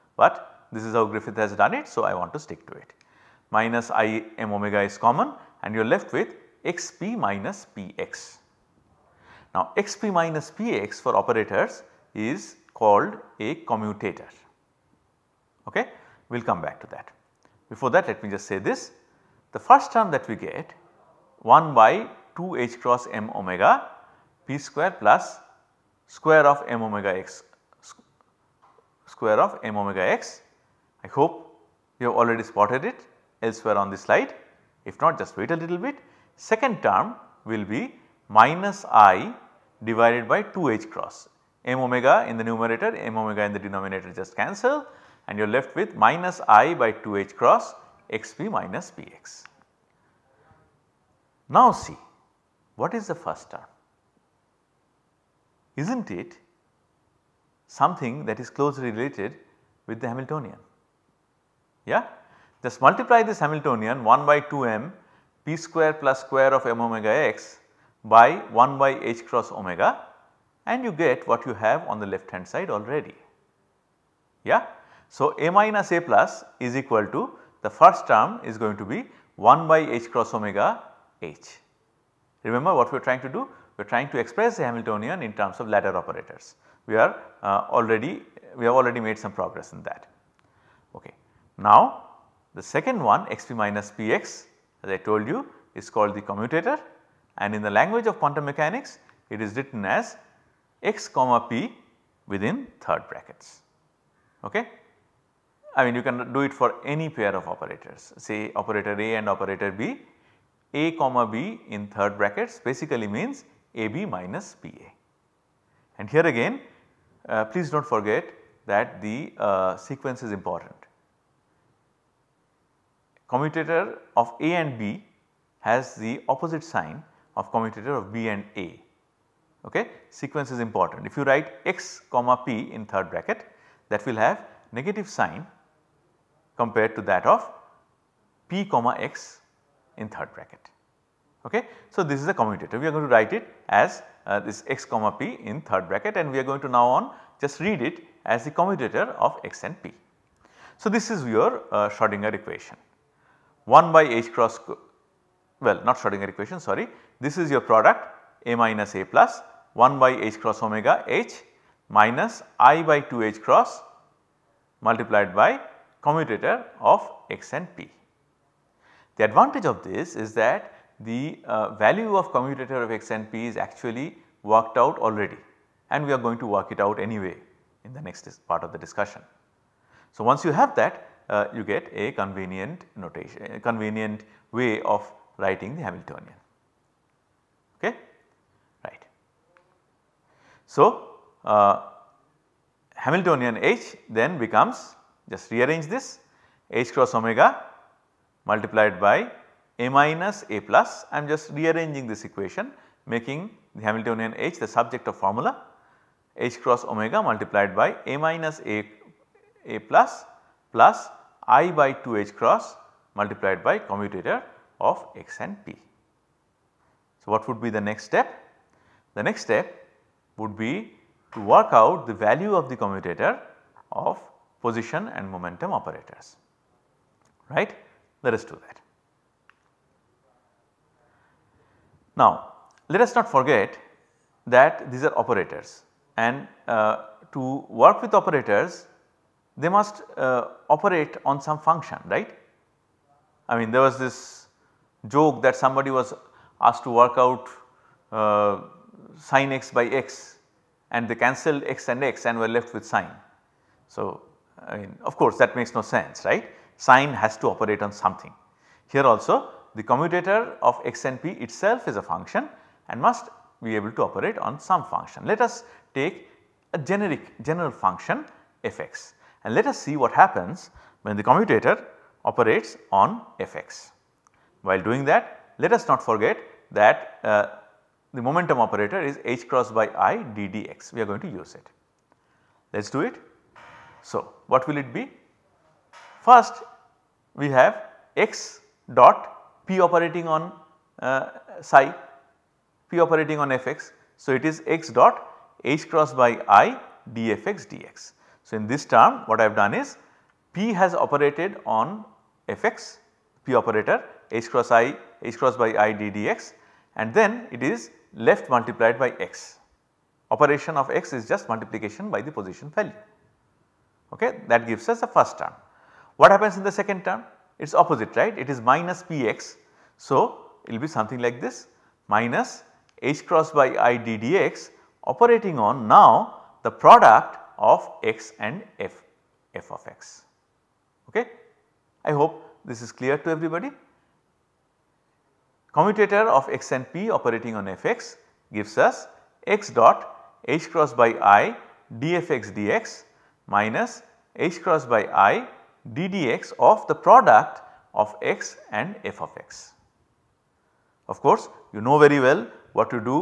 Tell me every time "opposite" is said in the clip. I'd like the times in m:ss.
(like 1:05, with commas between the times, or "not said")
2:06, 5:17.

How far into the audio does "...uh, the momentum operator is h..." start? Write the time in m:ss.
4:37.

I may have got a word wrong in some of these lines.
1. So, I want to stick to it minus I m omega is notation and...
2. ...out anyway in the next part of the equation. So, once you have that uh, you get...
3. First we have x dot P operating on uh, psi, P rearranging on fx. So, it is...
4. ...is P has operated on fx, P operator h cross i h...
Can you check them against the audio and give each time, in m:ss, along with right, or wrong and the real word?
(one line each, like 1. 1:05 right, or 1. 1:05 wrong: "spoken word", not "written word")
1. 0:01 wrong: "common", not "notation"
2. 2:56 wrong: "discussion", not "equation"
3. 4:46 wrong: "operating", not "rearranging"
4. 4:59 right.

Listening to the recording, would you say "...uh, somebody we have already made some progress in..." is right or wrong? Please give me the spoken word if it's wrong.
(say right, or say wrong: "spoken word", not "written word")
wrong: "already", not "somebody".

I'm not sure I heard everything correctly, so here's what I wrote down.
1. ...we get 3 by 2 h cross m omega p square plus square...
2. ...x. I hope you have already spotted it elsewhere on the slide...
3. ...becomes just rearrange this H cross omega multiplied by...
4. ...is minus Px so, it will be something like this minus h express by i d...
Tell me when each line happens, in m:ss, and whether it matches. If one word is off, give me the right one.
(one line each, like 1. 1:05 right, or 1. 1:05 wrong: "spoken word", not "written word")
1. 0:20 wrong: "1", not "3"
2. 0:30 right
3. 3:14 right
4. 5:18 wrong: "cross", not "express".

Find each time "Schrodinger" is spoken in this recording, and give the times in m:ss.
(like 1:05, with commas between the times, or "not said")
2:31, 2:35.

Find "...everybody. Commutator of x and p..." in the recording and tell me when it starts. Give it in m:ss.
5:33.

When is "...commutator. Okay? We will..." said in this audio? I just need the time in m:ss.
0:13.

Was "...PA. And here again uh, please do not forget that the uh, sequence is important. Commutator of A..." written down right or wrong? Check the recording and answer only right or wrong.
right.